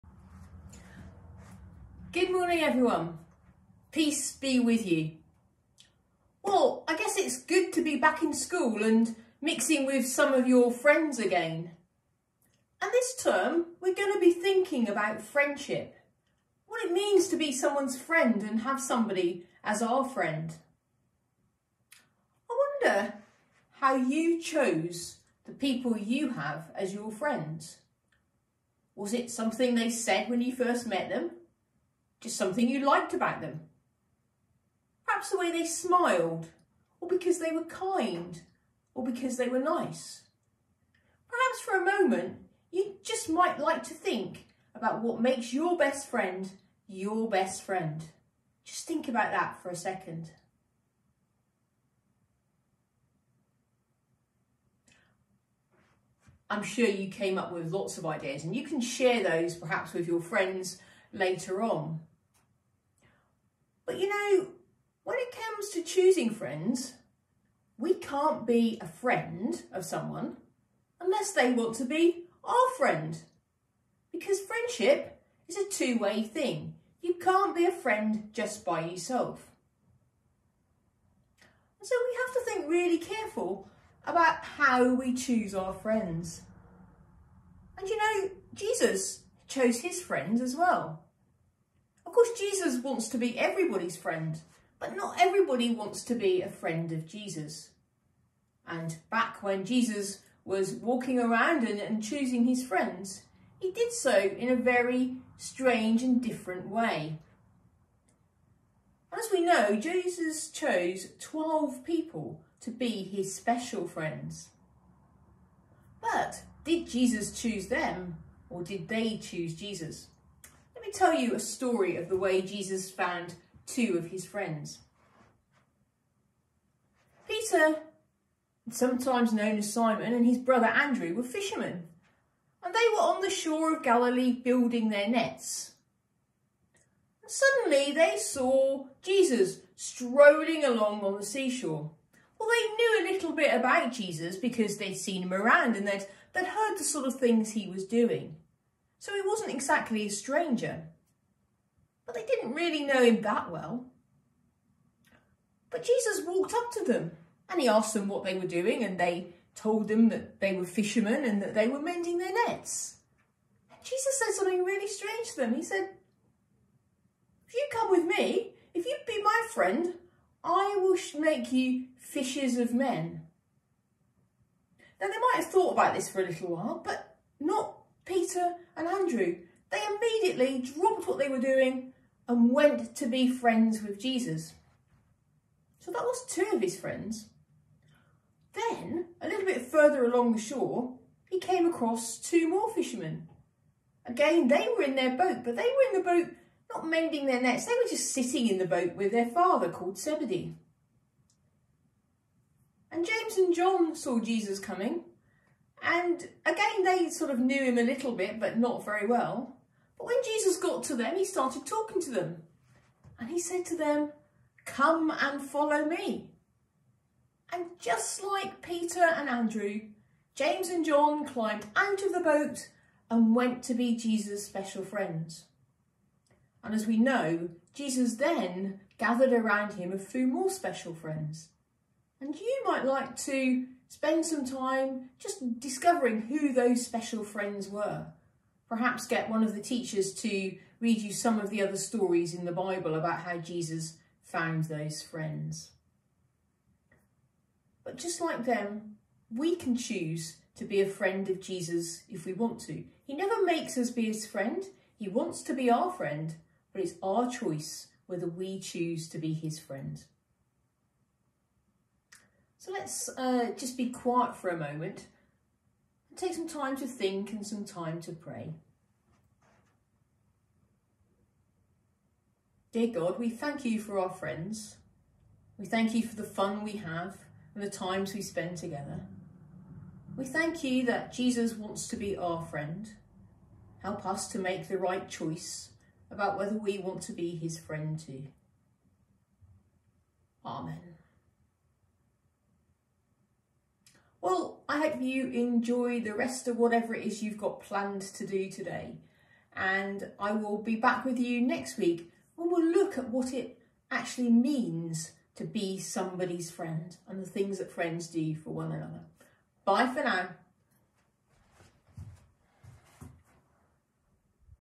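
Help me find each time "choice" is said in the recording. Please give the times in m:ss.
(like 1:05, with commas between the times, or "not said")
4:17, 4:45.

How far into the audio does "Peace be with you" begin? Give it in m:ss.
0:03.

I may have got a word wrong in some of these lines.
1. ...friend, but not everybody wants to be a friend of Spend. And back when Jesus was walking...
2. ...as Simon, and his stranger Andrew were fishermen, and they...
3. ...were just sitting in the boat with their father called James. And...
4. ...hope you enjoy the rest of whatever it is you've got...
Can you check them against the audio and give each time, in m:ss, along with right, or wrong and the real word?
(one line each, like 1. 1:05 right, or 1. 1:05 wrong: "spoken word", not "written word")
1. 1:33 wrong: "Jesus", not "Spend"
2. 2:09 wrong: "brother", not "stranger"
3. 3:17 wrong: "Zebedee", not "James"
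4. 4:54 right.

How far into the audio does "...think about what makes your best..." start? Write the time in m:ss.
0:43.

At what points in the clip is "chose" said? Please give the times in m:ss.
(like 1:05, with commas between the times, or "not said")
0:24, 1:29, 1:50.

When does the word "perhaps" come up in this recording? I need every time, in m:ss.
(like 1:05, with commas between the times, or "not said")
0:35, 0:41, 0:59, 3:58.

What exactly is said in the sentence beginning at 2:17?
And suddenly they saw Jesus strolling along on the seashore.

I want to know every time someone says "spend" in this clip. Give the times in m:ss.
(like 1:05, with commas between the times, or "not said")
3:53, 4:38.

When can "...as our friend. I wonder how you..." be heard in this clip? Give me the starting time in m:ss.
0:19.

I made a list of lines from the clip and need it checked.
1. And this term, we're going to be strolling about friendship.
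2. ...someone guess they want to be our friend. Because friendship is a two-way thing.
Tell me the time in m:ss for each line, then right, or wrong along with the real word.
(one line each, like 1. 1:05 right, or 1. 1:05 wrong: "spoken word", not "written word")
1. 0:12 wrong: "thinking", not "strolling"
2. 1:09 wrong: "unless", not "guess".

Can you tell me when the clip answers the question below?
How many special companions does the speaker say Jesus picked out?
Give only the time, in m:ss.
1:51.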